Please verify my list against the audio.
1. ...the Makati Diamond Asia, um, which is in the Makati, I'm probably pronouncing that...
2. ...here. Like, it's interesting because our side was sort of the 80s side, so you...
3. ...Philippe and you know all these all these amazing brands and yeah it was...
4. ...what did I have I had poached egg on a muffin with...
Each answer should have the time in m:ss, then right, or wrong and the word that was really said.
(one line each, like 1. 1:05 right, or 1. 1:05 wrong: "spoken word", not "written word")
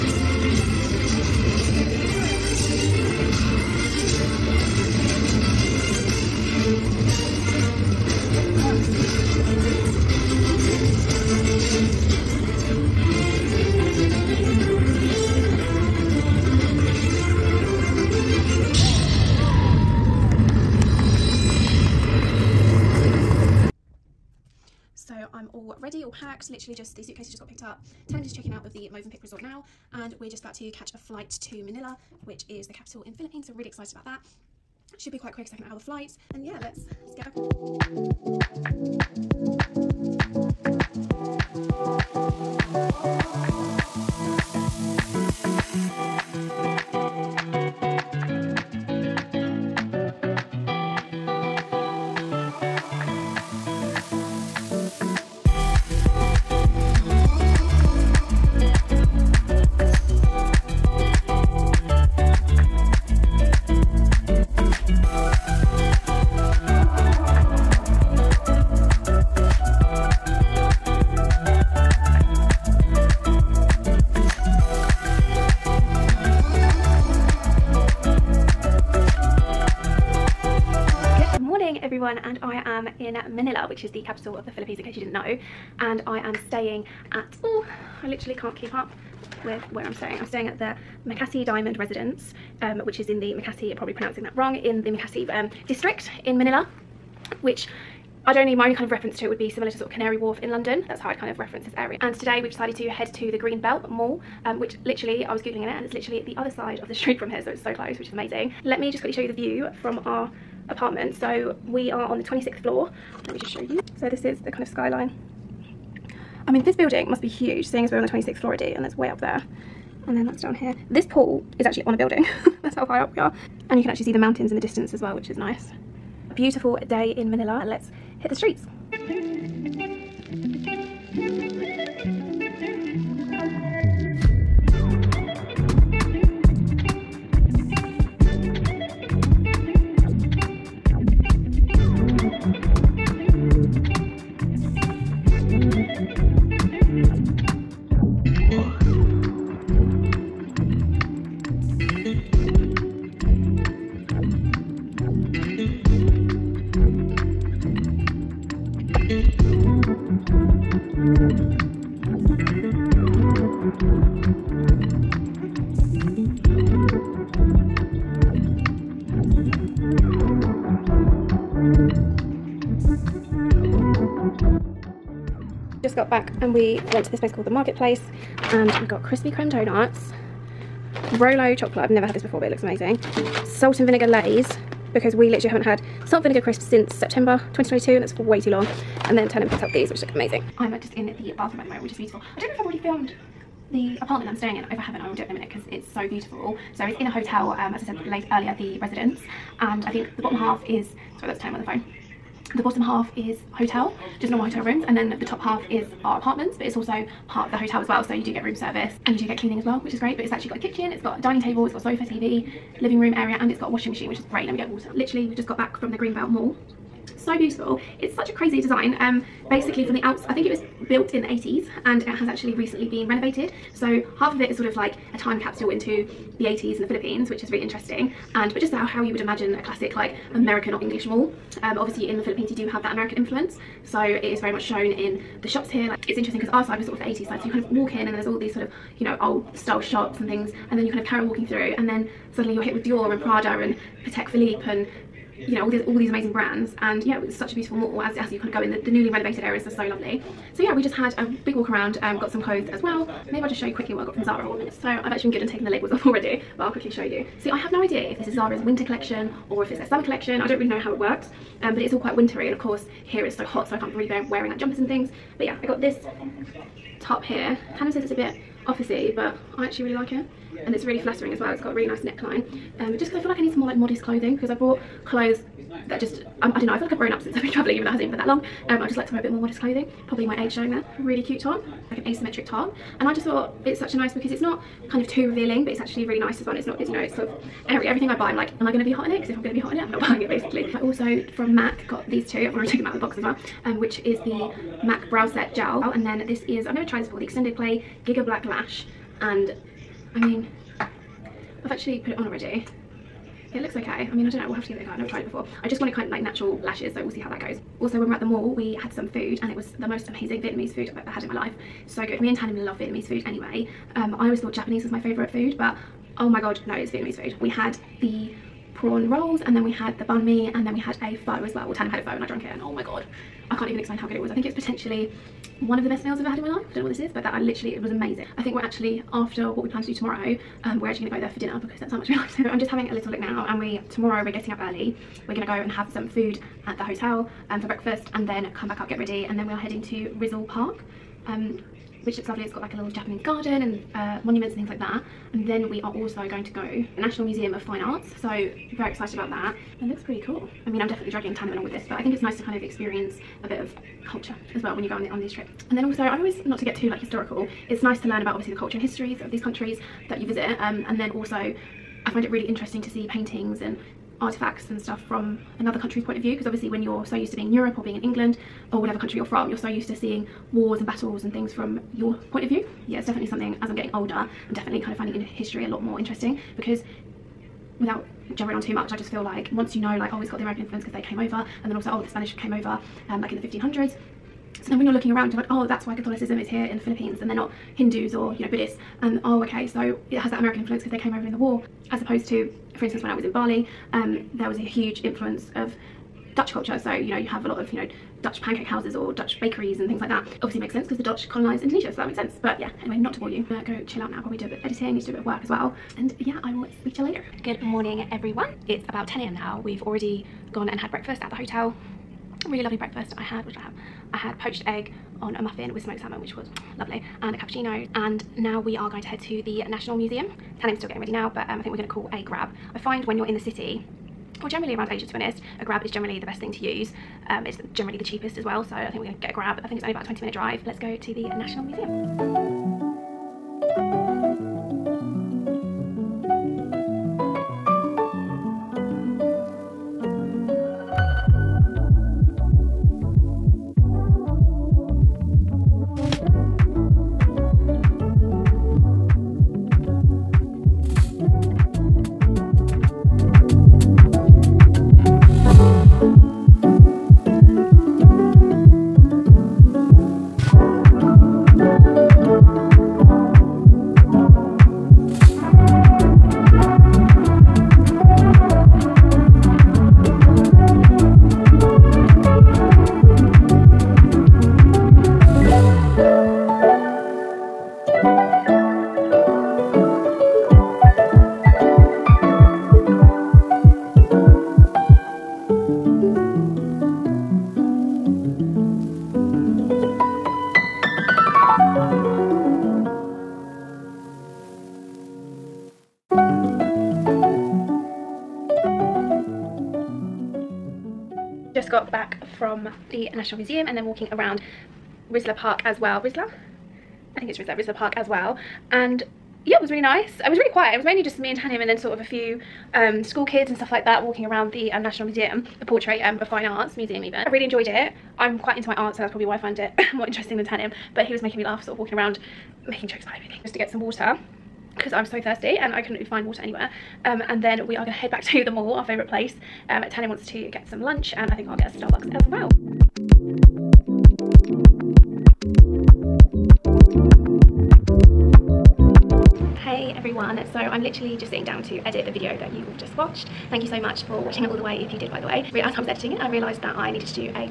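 1. 1:30 wrong: "Residence", not "Asia"
2. 3:55 right
3. 4:04 right
4. 6:53 right.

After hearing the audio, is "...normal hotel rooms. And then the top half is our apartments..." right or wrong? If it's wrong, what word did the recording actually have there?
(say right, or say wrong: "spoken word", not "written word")
right.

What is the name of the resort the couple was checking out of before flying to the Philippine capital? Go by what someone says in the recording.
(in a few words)
Movenpick Resort.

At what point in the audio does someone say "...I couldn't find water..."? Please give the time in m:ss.
8:45.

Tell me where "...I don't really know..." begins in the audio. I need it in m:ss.
4:20.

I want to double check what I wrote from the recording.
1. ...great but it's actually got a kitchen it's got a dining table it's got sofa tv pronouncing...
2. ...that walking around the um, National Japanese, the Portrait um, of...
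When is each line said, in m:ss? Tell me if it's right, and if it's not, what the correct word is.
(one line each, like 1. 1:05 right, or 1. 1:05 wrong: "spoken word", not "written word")
1. 3:29 wrong: "living", not "pronouncing"
2. 8:33 wrong: "Museum", not "Japanese".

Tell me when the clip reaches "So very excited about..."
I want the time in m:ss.
5:48.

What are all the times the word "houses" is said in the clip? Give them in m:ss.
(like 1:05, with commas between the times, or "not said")
6:38.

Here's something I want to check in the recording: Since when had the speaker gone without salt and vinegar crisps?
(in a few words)
September 2022.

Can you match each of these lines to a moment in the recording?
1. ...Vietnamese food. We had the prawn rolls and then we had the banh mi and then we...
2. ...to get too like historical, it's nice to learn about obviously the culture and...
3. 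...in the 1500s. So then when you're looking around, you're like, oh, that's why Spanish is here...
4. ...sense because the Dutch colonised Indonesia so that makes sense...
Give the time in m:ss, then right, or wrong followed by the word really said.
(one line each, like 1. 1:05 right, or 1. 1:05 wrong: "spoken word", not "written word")
1. 5:16 right
2. 5:56 right
3. 6:23 wrong: "Catholicism", not "Spanish"
4. 6:40 right.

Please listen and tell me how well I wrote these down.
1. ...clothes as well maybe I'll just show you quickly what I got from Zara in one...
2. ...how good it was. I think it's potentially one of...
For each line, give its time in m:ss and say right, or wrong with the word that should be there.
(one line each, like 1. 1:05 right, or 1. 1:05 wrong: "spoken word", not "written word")
1. 4:12 right
2. 5:23 right.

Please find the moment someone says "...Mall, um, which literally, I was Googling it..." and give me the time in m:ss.
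1:43.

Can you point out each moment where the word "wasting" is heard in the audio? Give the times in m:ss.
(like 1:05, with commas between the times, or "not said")
not said.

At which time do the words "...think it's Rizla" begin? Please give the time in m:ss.
8:27.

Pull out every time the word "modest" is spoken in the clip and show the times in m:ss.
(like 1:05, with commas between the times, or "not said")
4:33, 4:39.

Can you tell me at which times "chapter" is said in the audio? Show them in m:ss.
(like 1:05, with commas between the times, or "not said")
not said.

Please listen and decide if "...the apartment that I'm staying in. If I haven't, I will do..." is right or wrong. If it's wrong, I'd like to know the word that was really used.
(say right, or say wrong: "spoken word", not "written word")
right.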